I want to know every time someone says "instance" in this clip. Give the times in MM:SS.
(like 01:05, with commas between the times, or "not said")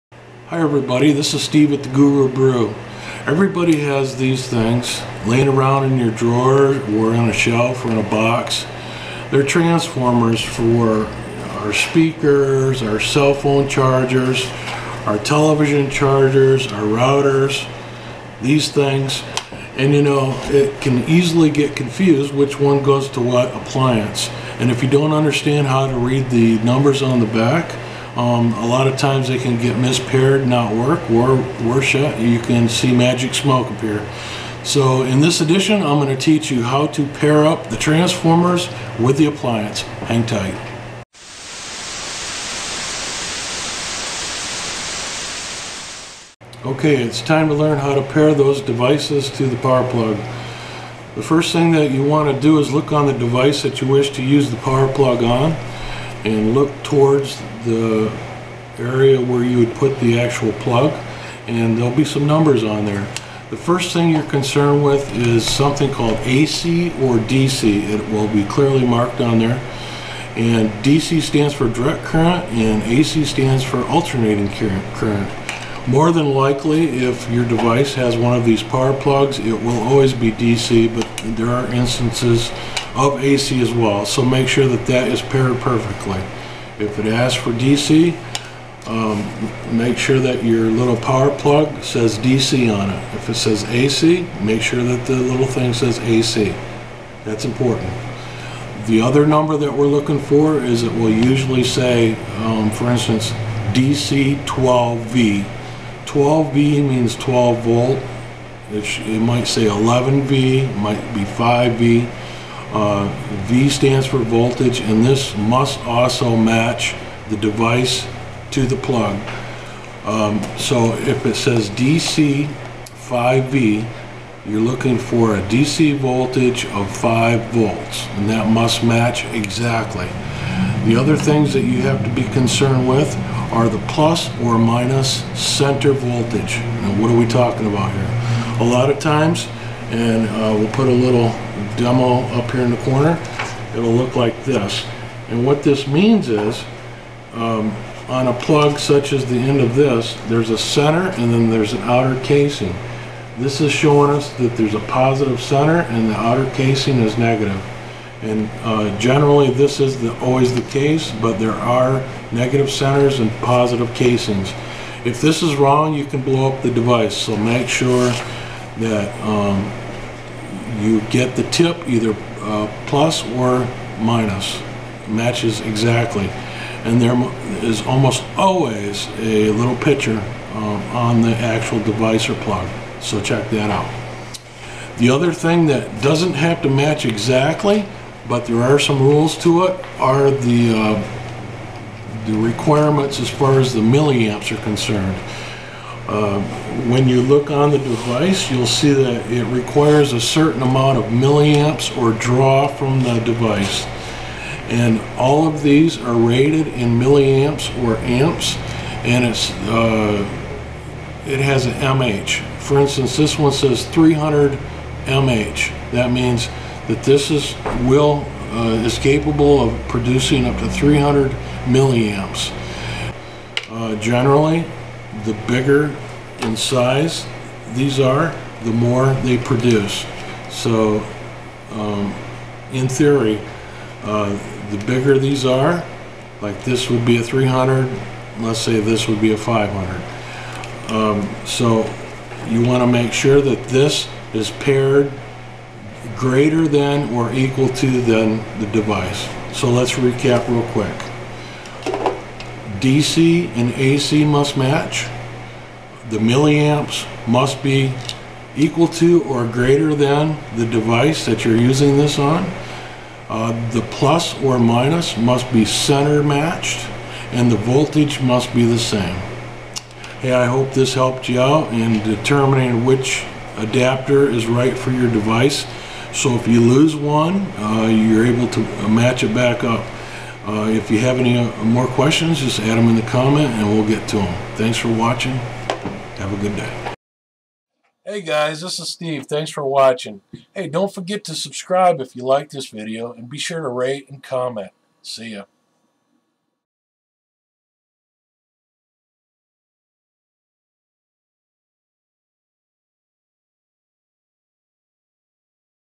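01:21, 01:42, 03:32.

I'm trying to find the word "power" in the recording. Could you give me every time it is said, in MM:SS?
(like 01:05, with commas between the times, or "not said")
00:49, 00:54, 01:18, 01:30.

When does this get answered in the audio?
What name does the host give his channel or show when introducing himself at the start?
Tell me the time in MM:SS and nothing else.
00:01.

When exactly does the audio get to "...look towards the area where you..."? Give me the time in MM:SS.
00:56.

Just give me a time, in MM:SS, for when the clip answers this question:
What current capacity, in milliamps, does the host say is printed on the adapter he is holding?
03:33.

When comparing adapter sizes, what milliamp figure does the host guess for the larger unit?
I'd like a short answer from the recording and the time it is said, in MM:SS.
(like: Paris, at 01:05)
500, at 03:59.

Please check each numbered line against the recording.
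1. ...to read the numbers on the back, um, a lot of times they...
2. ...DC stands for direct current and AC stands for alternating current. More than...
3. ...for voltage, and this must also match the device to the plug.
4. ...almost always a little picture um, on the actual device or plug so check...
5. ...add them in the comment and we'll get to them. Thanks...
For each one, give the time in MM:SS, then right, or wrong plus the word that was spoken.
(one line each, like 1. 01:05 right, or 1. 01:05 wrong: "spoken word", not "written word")
1. 00:25 right
2. 01:10 right
3. 01:54 right
4. 02:57 right
5. 04:42 right.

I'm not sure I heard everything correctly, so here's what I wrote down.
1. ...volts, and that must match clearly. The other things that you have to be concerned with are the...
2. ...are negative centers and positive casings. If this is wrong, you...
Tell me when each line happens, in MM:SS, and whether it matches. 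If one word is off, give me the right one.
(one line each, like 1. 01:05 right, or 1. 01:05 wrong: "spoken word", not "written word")
1. 02:07 wrong: "exactly", not "clearly"
2. 02:41 right.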